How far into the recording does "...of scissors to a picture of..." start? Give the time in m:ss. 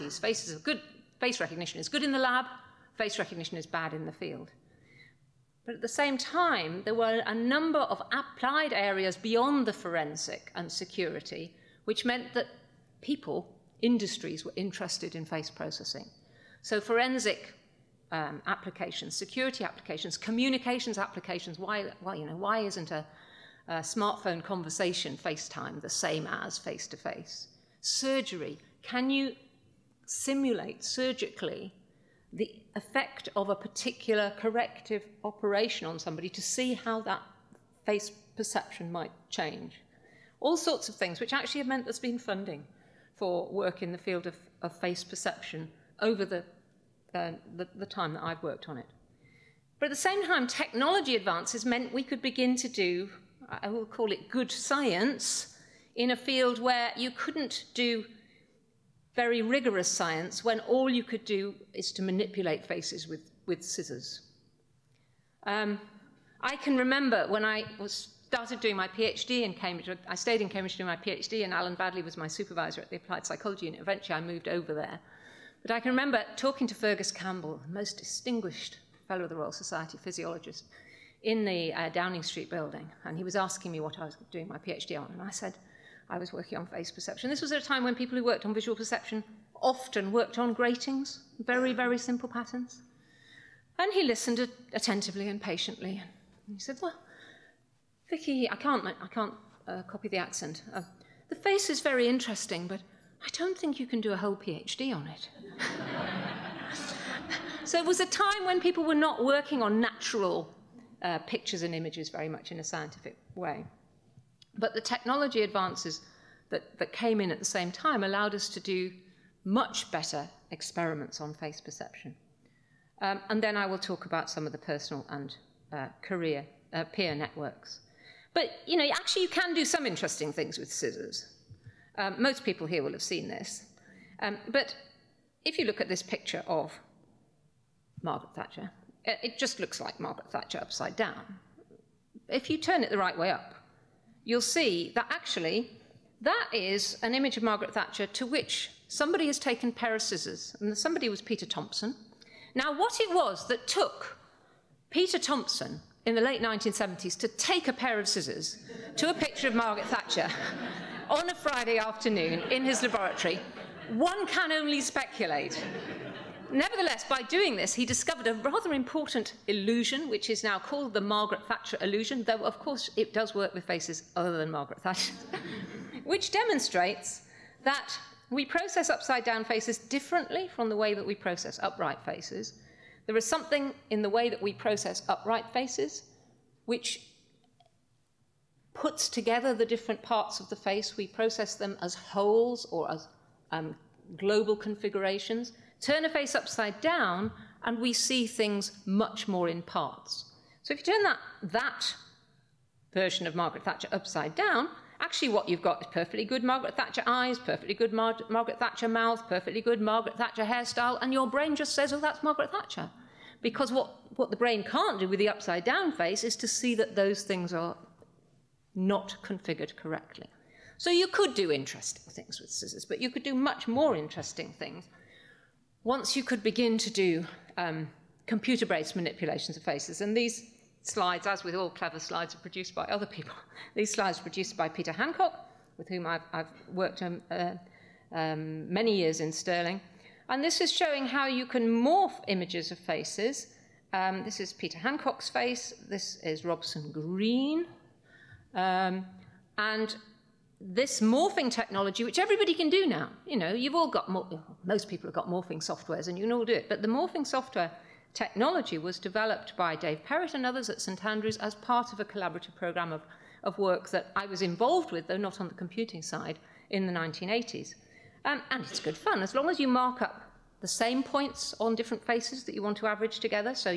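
2:37.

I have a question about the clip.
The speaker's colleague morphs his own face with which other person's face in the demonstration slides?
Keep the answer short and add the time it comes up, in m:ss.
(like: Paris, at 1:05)
Robson Green, at 4:06.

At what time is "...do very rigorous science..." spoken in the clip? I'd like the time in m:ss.
0:57.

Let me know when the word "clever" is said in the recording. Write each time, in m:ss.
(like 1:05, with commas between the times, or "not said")
3:51.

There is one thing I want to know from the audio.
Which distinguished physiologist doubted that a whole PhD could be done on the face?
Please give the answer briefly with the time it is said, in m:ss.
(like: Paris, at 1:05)
Fergus Campbell, at 1:16.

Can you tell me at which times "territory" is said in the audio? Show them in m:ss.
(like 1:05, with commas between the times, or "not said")
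not said.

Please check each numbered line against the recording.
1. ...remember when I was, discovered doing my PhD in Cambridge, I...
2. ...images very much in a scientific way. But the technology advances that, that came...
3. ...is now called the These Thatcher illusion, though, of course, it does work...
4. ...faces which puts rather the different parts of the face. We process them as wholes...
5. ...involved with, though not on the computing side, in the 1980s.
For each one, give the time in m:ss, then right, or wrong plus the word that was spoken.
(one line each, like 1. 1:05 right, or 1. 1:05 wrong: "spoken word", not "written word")
1. 1:06 wrong: "started", not "discovered"
2. 1:51 right
3. 2:50 wrong: "Margaret", not "These"
4. 3:05 wrong: "together", not "rather"
5. 4:24 right.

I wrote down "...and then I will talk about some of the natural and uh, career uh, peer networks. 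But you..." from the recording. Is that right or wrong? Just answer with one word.
wrong.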